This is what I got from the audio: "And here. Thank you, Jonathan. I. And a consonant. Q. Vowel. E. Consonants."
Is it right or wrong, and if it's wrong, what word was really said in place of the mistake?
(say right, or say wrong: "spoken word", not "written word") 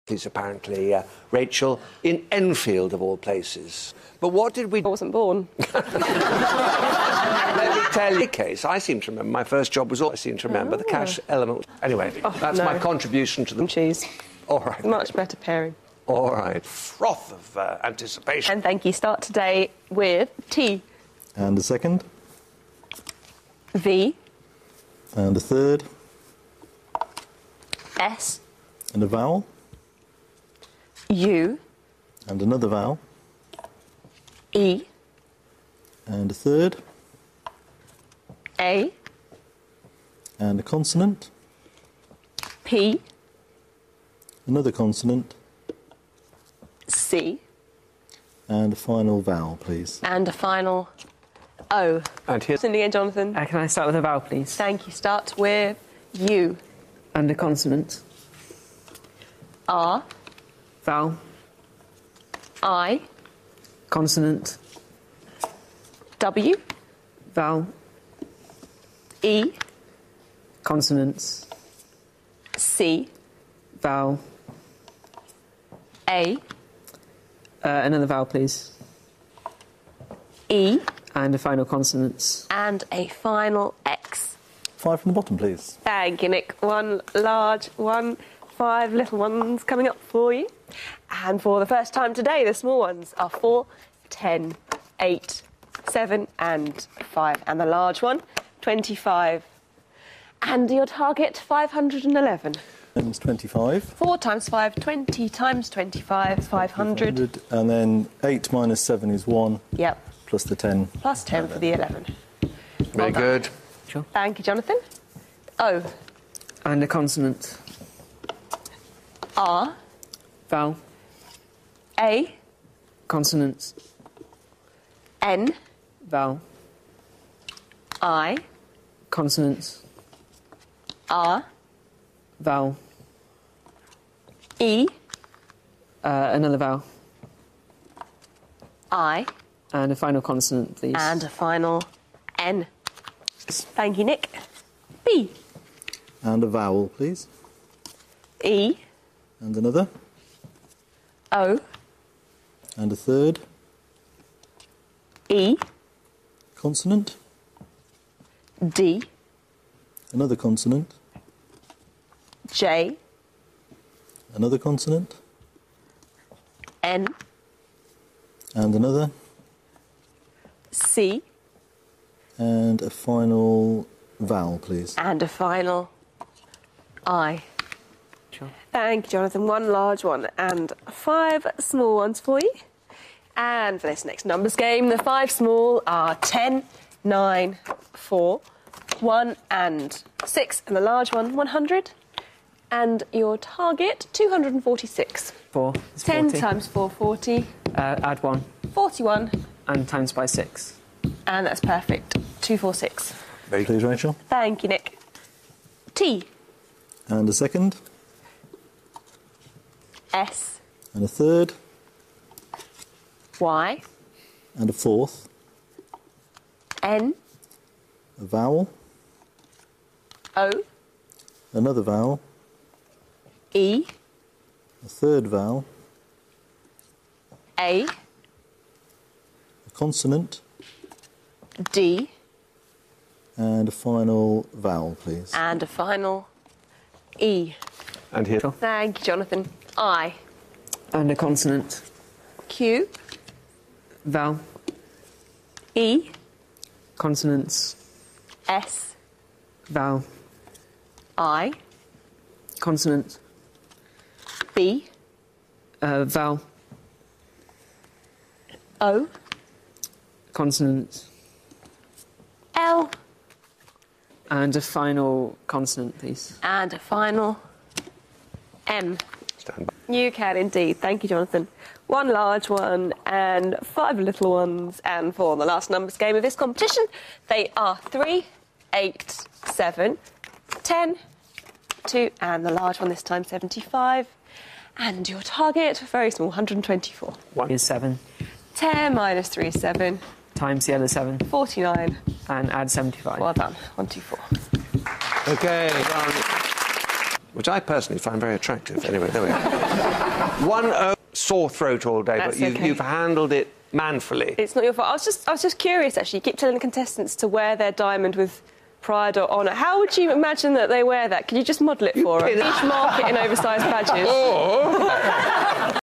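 right.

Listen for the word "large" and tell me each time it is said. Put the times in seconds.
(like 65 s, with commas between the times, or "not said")
87 s, 97 s, 179 s, 190 s, 272 s, 282 s.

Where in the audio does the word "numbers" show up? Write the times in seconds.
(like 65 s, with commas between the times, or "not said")
184 s, 275 s.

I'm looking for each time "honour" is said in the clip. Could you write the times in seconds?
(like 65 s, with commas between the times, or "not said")
309 s.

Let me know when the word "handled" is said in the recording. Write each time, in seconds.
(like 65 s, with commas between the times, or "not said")
302 s.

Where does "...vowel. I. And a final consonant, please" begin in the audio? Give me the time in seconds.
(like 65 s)
136 s.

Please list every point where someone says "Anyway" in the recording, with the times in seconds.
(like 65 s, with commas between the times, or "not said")
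11 s, 298 s.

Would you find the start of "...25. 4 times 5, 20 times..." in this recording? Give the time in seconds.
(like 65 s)
103 s.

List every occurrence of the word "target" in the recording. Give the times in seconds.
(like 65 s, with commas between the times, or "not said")
100 s, 193 s, 285 s.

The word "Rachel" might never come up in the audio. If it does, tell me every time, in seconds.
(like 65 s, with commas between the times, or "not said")
1 s, 178 s, 203 s.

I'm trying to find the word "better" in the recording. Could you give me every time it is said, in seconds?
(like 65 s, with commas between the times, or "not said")
15 s.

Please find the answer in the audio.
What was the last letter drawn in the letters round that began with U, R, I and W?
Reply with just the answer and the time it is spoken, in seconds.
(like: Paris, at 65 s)
X, at 83 s.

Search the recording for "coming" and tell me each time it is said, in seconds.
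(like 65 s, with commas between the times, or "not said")
89 s.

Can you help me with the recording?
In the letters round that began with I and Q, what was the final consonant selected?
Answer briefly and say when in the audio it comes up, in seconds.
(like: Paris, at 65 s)
M, at 268 s.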